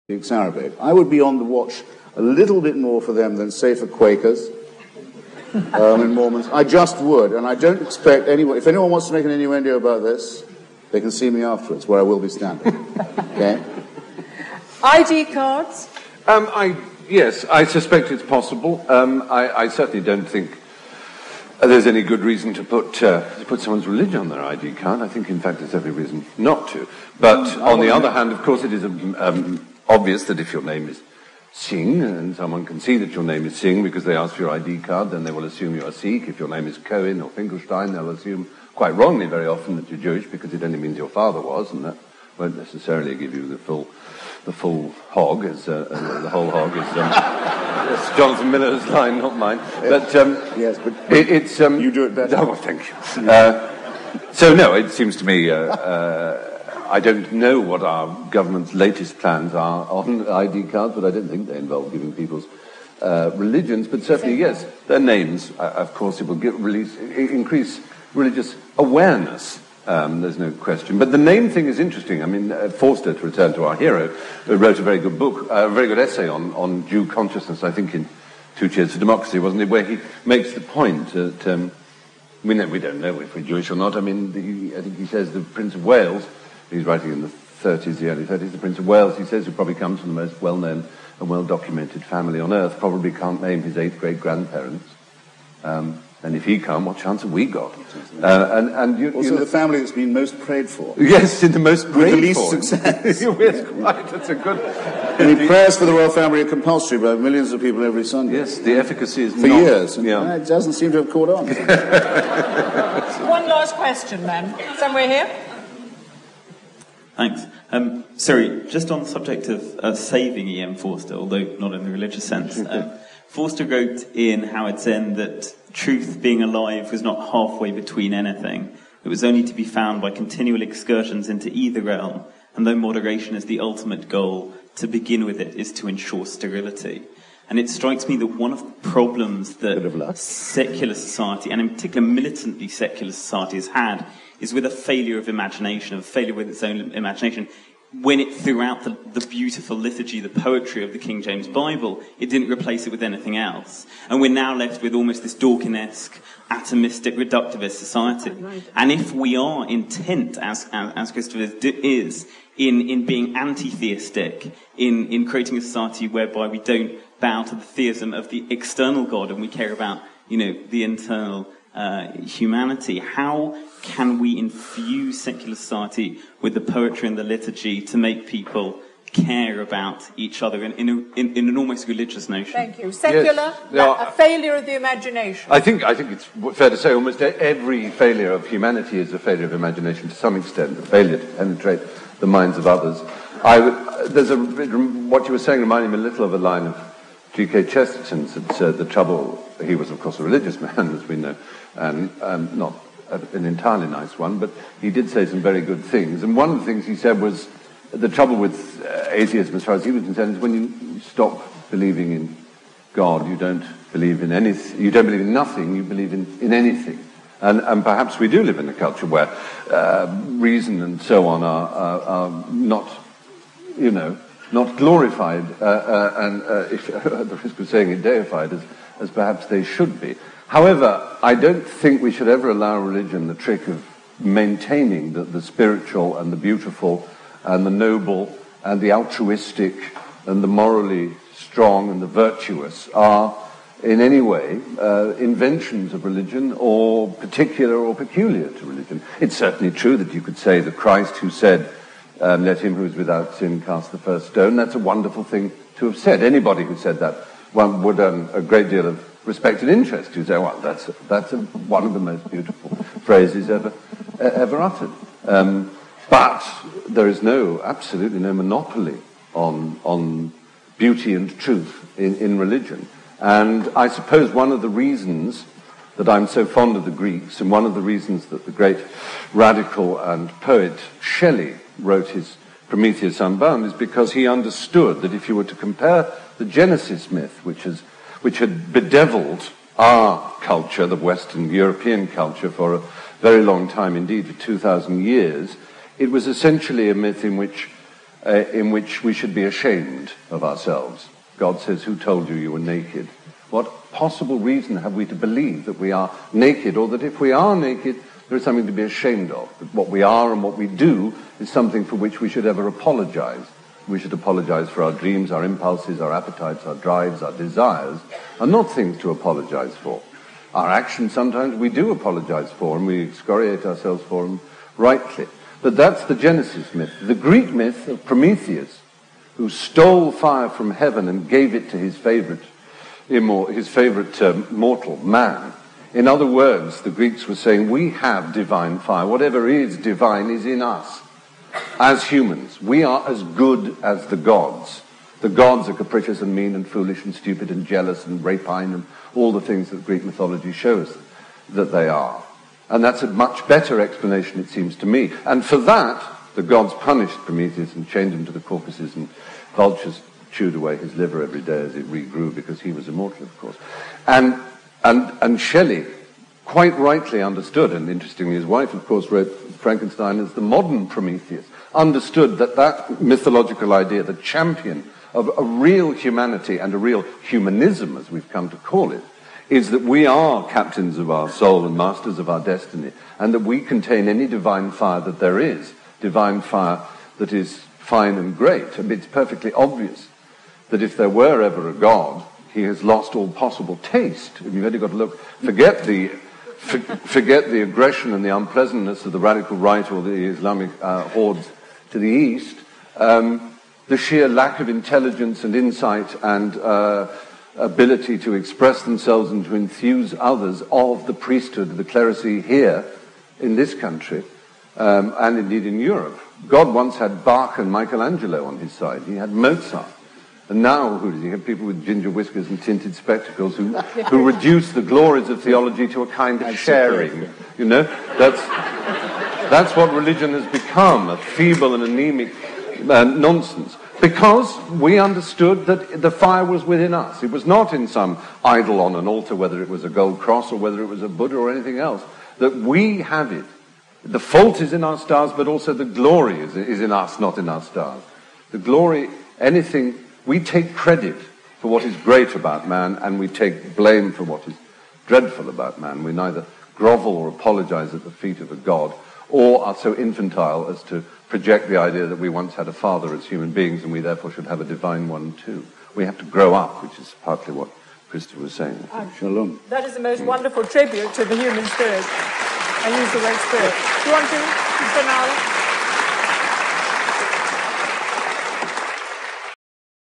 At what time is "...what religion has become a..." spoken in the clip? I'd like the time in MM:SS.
07:09.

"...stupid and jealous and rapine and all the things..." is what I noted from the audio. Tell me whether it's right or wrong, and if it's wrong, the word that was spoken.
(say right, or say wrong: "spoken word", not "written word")
right.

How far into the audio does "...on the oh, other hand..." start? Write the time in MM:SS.
00:27.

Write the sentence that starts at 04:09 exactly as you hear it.
It's certainly true that you could say that Christ, who said, um, let him who is without sin cast the first stone.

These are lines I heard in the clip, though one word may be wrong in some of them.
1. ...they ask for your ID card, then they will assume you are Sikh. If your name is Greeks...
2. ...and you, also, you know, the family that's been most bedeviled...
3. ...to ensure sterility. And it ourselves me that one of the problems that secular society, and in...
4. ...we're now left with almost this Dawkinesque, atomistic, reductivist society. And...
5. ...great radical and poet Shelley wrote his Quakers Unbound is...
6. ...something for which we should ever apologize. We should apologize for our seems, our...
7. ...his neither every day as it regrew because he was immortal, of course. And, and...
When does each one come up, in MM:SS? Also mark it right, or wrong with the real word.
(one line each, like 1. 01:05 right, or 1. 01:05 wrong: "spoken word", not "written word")
1. 00:34 wrong: "Cohen", not "Greeks"
2. 01:38 wrong: "prayed", not "bedeviled"
3. 02:15 wrong: "strikes", not "ourselves"
4. 02:34 right
5. 04:38 wrong: "Prometheus", not "Quakers"
6. 05:11 wrong: "dreams", not "seems"
7. 06:00 wrong: "liver", not "neither".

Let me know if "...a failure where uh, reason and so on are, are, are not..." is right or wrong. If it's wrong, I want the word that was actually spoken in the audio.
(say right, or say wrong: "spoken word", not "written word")
wrong: "culture", not "failure".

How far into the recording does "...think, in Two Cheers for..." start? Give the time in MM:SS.
01:17.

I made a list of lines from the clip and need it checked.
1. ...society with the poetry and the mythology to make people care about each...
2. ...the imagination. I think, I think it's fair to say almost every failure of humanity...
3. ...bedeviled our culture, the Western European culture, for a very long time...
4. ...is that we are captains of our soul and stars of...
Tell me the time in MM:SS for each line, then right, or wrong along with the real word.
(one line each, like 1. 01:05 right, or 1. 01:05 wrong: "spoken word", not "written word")
1. 02:55 wrong: "liturgy", not "mythology"
2. 03:04 right
3. 04:48 right
4. 06:19 wrong: "masters", not "stars".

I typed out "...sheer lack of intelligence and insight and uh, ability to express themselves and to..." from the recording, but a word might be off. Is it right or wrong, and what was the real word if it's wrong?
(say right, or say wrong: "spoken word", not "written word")
right.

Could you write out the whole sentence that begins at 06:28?
I mean, it's perfectly obvious that if there were ever a God, he has lost all possible taste.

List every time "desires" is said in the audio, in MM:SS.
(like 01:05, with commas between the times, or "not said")
05:17.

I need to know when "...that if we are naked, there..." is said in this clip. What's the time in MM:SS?
05:06.